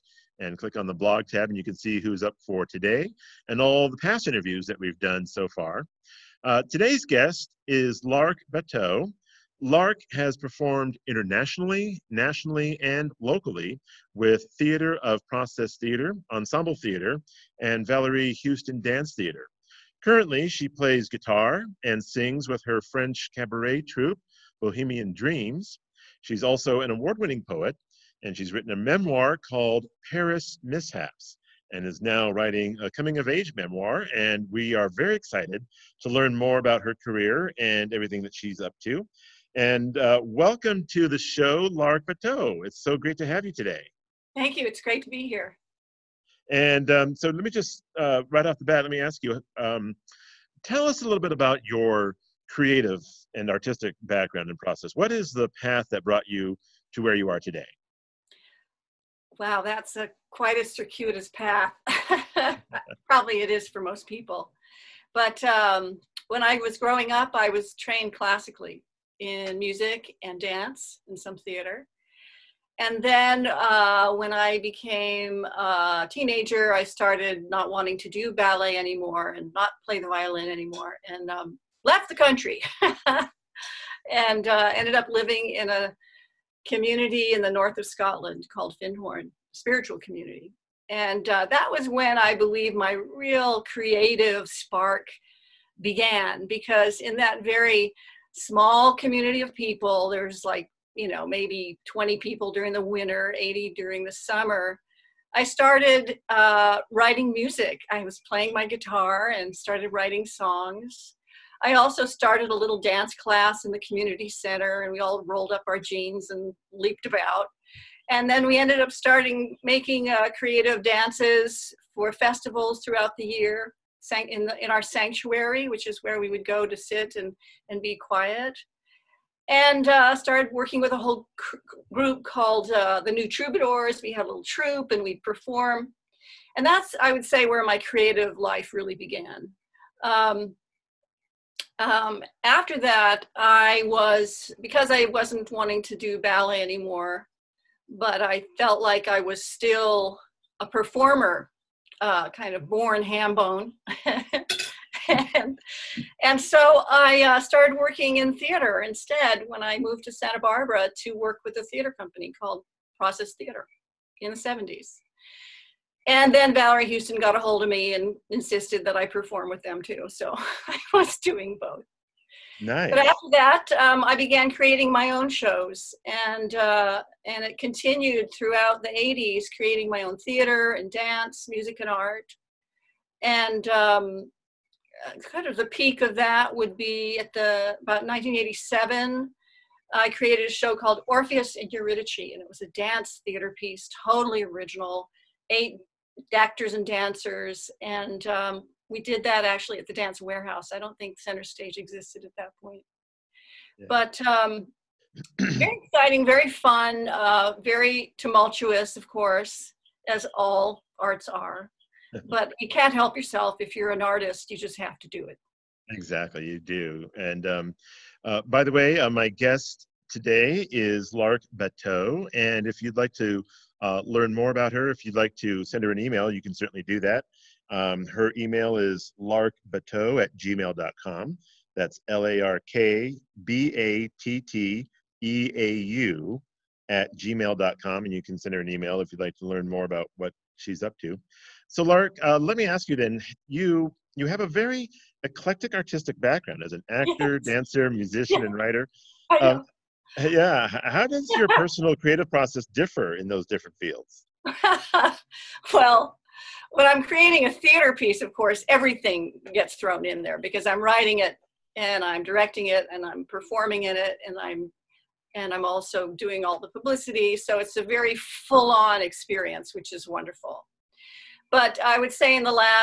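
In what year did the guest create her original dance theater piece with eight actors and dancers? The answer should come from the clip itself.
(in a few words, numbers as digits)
1987.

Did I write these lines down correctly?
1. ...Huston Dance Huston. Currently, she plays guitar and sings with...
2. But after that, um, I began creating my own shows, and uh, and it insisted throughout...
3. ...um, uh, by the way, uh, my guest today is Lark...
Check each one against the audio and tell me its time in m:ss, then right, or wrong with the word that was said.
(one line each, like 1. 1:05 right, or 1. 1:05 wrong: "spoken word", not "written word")
1. 0:18 wrong: "Theater", not "Huston"
2. 2:52 wrong: "continued", not "insisted"
3. 3:37 right.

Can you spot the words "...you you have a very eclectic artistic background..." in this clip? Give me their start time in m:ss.
4:03.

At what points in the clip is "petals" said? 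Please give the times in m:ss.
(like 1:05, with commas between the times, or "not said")
not said.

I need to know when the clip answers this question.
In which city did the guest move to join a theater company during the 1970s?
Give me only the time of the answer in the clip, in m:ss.
2:40.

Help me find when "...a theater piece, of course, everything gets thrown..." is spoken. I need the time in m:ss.
4:17.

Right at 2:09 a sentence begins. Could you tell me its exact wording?
And uh, started working with a whole group called uh, the New Troubadours.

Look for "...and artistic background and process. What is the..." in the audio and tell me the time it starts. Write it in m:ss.
0:53.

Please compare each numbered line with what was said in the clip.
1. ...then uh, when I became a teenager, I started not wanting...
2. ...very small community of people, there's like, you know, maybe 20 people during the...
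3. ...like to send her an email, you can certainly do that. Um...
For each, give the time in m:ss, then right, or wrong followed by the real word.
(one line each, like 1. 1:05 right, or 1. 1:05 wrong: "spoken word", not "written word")
1. 1:13 right
2. 1:37 right
3. 3:45 right.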